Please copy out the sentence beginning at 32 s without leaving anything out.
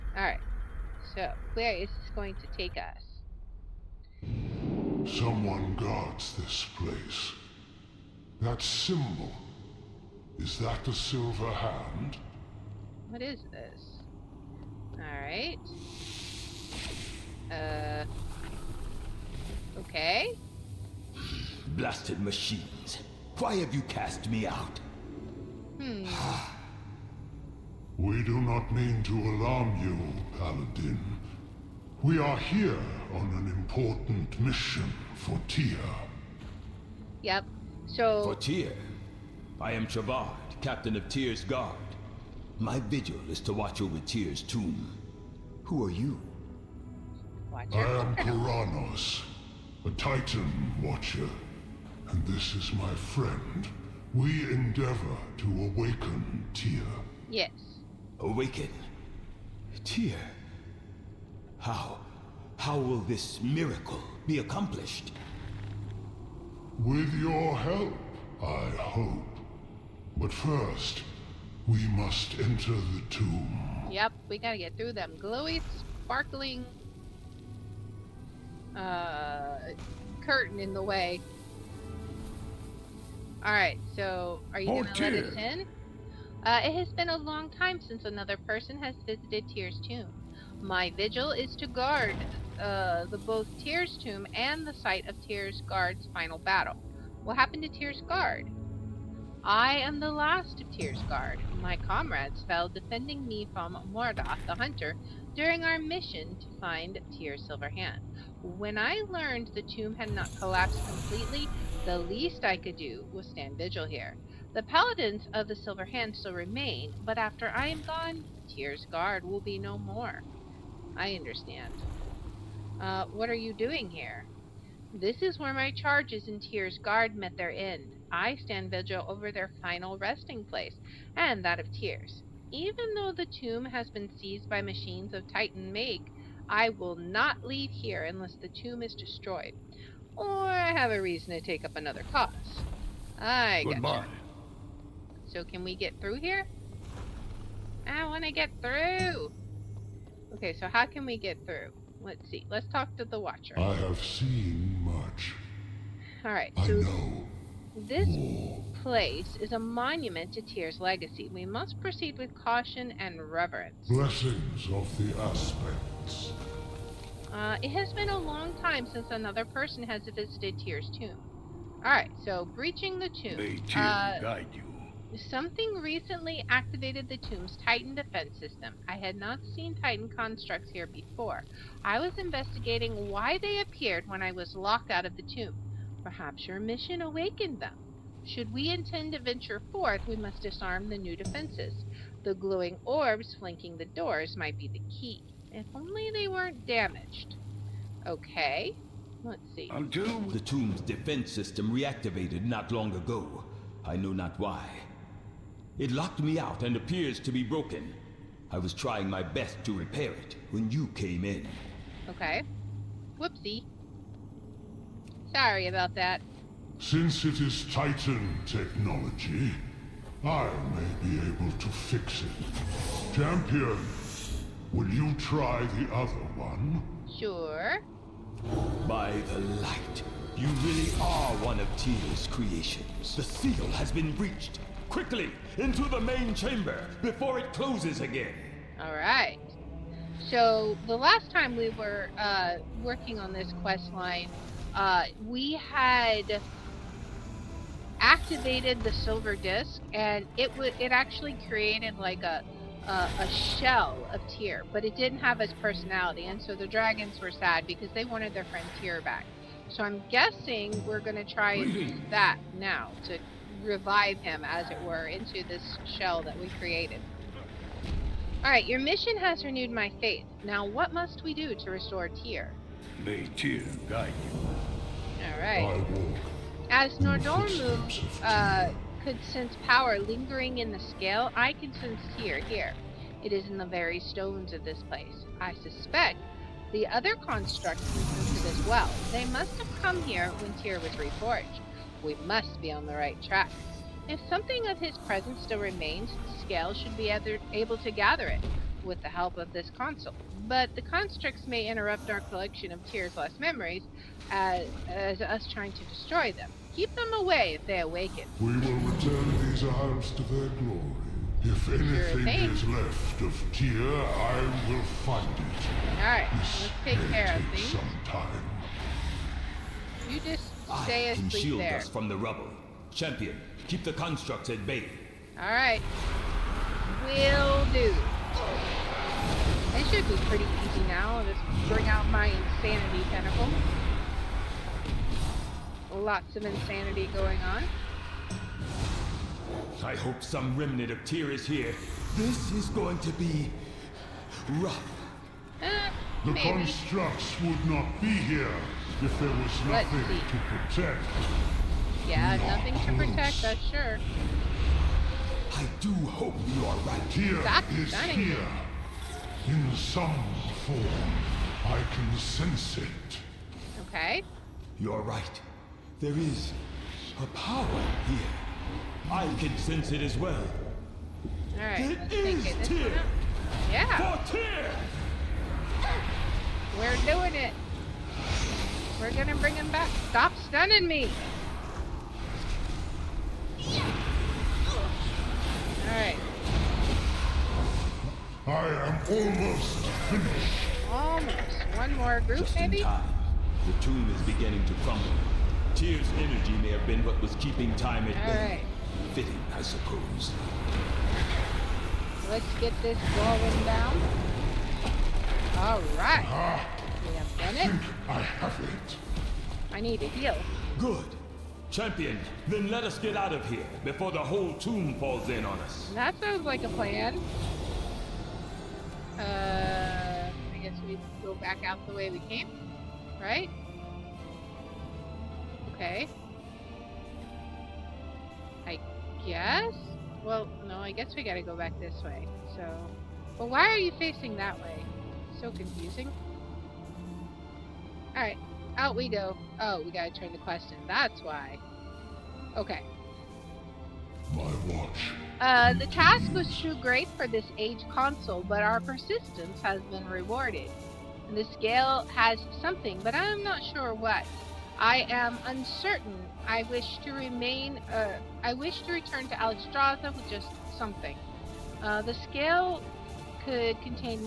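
We are here on an important mission for Tyr.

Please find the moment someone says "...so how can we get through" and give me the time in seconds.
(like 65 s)
150 s.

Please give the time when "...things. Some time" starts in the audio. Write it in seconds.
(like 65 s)
317 s.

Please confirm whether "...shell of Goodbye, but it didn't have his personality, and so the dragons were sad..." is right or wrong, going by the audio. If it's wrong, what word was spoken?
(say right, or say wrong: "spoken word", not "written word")
wrong: "Tyr", not "Goodbye".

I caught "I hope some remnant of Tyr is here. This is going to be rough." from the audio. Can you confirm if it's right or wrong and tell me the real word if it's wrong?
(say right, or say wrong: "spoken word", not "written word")
right.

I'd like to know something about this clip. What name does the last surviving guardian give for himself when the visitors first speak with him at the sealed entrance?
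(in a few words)
Travard.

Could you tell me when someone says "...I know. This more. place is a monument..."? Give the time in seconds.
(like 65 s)
156 s.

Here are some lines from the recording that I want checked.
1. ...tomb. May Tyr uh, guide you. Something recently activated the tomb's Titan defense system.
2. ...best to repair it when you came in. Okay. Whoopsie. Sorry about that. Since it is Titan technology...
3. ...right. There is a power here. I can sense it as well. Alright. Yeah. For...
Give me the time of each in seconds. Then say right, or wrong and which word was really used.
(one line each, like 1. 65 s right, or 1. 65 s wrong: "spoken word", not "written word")
1. 173 s right
2. 209 s right
3. 365 s right.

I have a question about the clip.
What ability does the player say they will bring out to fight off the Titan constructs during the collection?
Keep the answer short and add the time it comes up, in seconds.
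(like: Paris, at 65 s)
Insanity tentacle, at 332 s.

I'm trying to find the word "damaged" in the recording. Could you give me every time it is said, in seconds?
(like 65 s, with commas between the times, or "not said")
196 s.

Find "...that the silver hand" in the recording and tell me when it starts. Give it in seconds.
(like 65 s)
10 s.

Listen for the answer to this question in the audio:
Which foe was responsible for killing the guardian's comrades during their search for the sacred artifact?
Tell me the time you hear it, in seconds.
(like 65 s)
103 s.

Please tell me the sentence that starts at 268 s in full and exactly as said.
Alright, your mission has renewed my faith.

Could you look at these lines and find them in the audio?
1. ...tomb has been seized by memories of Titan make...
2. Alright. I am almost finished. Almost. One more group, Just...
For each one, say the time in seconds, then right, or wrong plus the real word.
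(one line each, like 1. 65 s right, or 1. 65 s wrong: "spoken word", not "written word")
1. 133 s wrong: "machines", not "memories"
2. 385 s right.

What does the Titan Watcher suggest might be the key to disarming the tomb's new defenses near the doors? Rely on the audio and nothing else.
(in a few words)
The glowing orbs.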